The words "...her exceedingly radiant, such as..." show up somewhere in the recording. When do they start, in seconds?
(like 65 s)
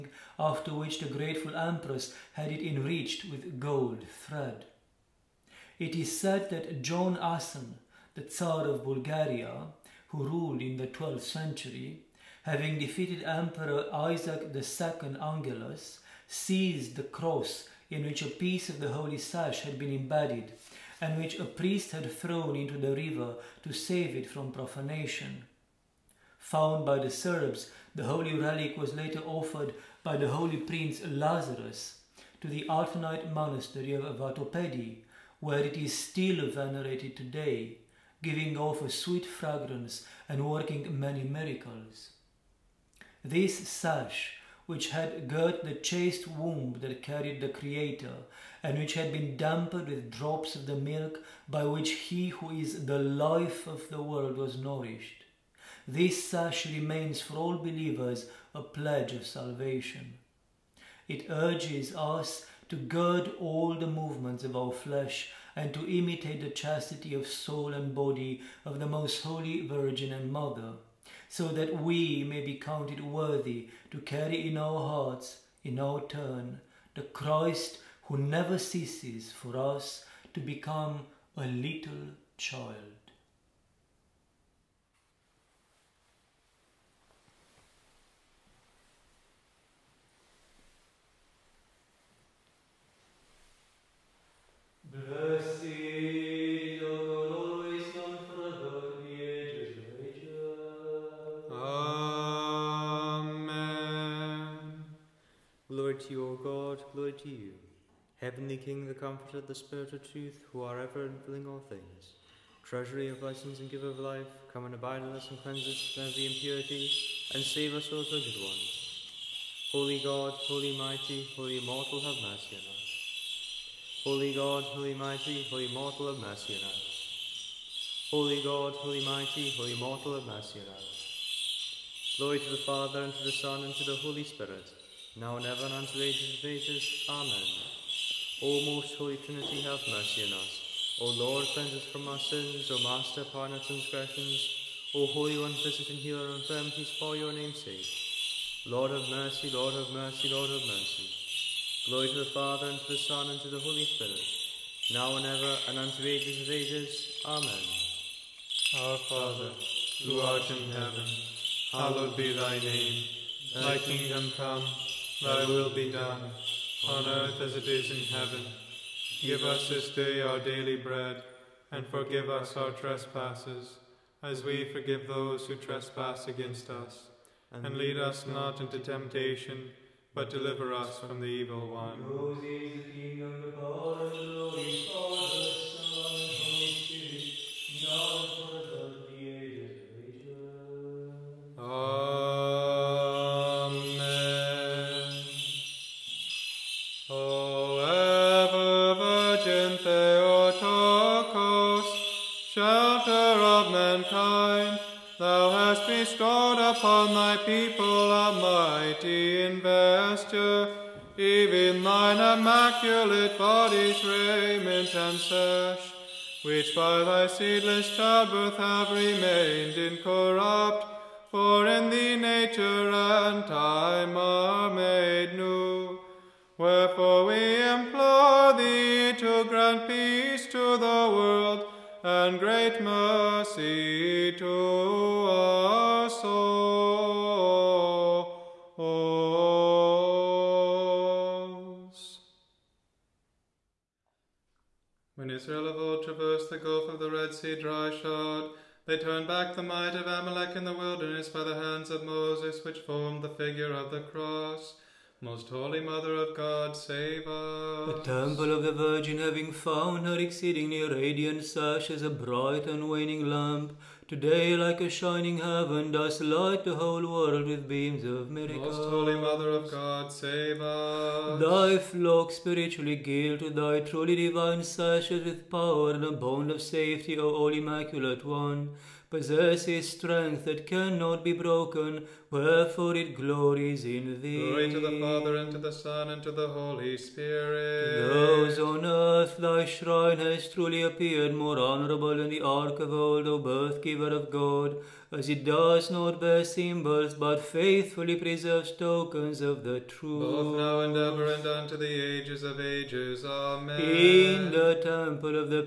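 260 s.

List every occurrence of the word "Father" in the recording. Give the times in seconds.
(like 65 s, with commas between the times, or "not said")
132 s, 152 s, 158 s, 285 s.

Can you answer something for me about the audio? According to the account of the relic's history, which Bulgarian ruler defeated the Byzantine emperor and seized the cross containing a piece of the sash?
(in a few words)
John Asen.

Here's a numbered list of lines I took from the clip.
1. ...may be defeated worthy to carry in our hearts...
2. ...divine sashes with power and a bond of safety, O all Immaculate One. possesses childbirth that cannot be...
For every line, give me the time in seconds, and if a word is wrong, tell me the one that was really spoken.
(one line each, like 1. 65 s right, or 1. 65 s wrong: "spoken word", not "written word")
1. 72 s wrong: "counted", not "defeated"
2. 274 s wrong: "strength", not "childbirth".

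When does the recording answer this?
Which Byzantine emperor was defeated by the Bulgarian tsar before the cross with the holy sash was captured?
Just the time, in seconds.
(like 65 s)
13 s.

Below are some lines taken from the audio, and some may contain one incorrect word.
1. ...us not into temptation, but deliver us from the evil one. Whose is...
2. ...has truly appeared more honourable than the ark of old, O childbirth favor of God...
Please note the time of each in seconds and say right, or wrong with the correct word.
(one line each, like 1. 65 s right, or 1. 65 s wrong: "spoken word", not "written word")
1. 177 s right
2. 290 s wrong: "birth", not "childbirth".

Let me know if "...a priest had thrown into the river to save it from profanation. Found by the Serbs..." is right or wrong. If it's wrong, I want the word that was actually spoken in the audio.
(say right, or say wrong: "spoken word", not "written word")
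right.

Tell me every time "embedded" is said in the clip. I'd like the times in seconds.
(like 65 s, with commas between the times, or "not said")
19 s.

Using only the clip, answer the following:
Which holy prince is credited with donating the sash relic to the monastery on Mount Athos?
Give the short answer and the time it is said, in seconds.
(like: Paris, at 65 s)
Lazarus, at 31 s.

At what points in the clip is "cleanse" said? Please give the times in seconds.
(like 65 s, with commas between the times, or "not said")
115 s, 141 s.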